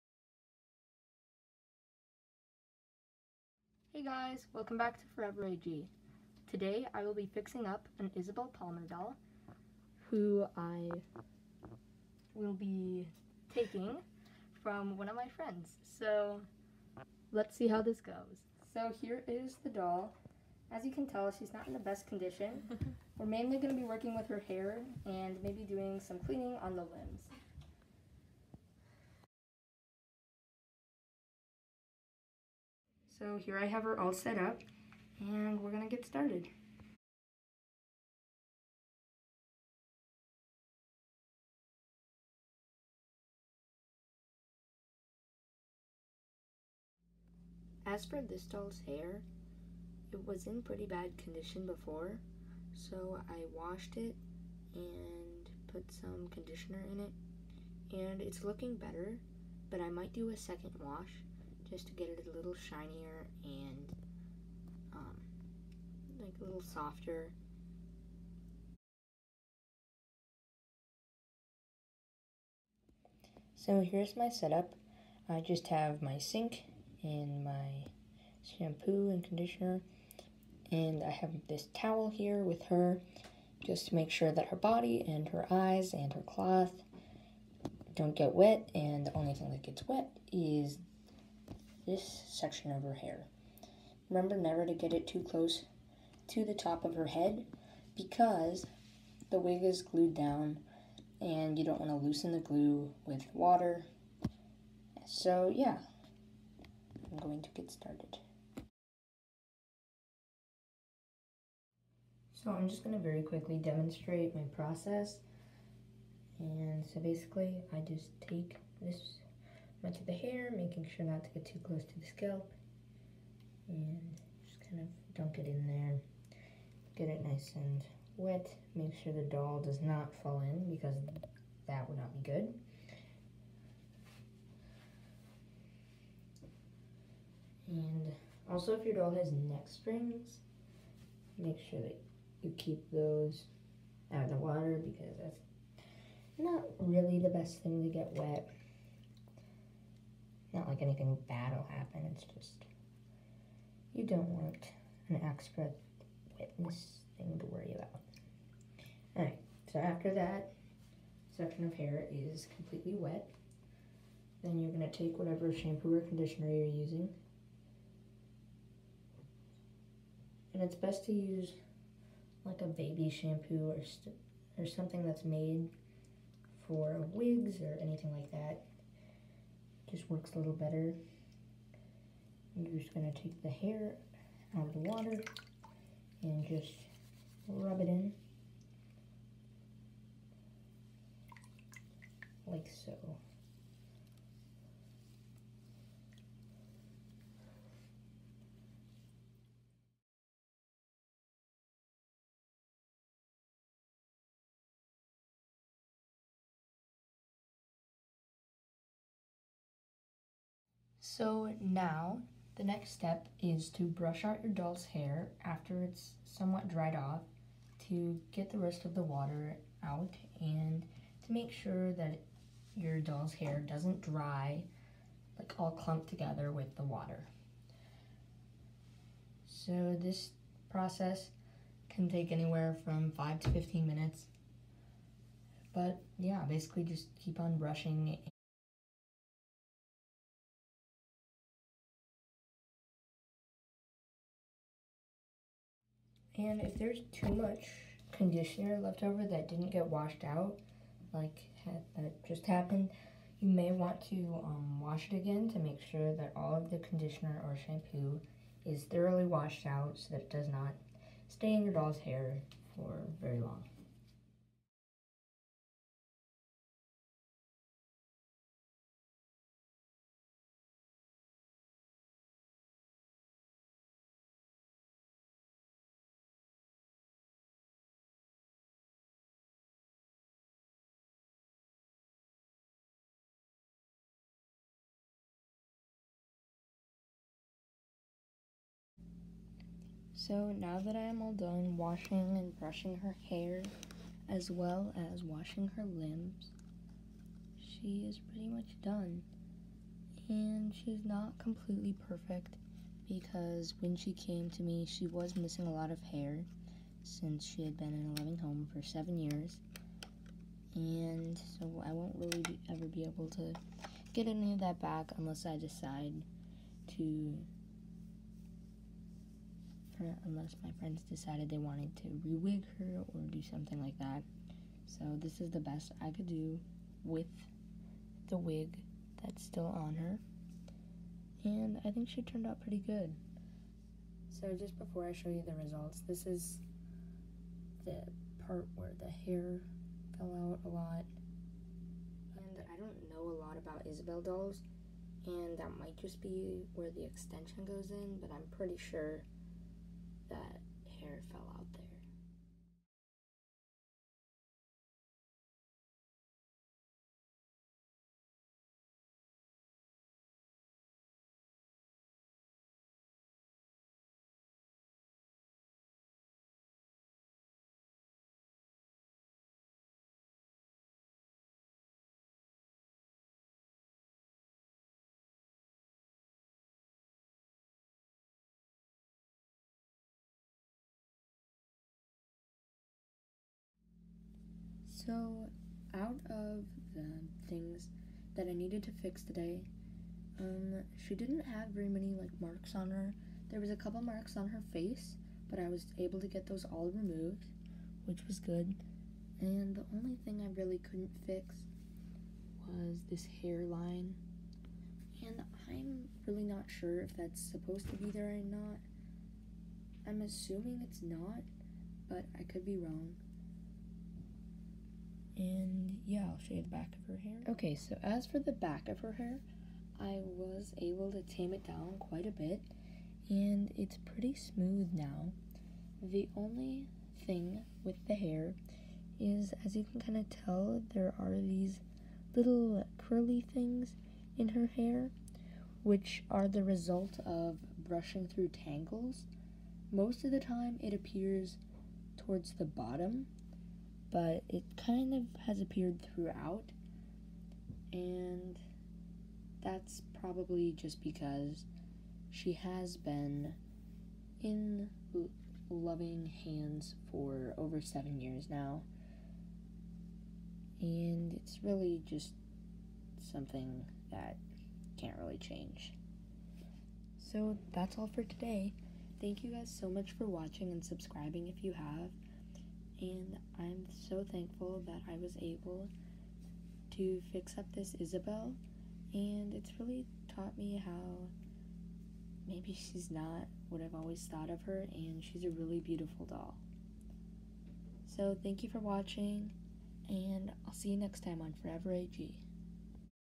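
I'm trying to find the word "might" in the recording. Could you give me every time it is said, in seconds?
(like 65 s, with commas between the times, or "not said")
59 s, 345 s.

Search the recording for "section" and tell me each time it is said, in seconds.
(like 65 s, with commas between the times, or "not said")
92 s, 161 s.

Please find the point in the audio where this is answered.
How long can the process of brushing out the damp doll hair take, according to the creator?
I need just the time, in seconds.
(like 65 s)
233 s.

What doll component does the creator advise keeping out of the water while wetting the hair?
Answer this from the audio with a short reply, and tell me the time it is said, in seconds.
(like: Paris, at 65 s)
Neck springs, at 139 s.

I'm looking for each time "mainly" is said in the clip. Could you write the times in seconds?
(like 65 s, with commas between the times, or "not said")
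23 s.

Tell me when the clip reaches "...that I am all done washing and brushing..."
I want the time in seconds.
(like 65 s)
290 s.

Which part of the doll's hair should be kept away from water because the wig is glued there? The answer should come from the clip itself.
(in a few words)
The top of her head.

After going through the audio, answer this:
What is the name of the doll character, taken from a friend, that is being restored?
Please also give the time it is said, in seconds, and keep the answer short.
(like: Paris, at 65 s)
Isabelle Palmer, at 8 s.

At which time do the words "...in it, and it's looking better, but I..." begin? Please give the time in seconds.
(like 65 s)
56 s.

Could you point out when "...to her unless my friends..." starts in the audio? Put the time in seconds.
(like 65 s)
316 s.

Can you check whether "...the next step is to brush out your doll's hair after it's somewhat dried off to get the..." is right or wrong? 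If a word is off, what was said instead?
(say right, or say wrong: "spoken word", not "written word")
right.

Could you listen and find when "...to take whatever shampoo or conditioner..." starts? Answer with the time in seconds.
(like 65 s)
164 s.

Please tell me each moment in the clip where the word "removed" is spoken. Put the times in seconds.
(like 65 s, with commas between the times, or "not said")
396 s.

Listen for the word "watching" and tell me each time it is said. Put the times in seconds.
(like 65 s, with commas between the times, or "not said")
470 s, 488 s.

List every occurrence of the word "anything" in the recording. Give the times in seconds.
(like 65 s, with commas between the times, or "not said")
150 s, 177 s.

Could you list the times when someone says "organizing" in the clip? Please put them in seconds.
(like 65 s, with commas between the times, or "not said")
not said.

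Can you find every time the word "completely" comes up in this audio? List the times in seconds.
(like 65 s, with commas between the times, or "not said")
162 s, 301 s.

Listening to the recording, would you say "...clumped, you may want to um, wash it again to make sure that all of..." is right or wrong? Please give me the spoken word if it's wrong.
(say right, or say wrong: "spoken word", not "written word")
wrong: "happened", not "clumped".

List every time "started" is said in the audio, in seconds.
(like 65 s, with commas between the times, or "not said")
36 s, 107 s.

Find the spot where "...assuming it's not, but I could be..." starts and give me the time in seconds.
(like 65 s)
410 s.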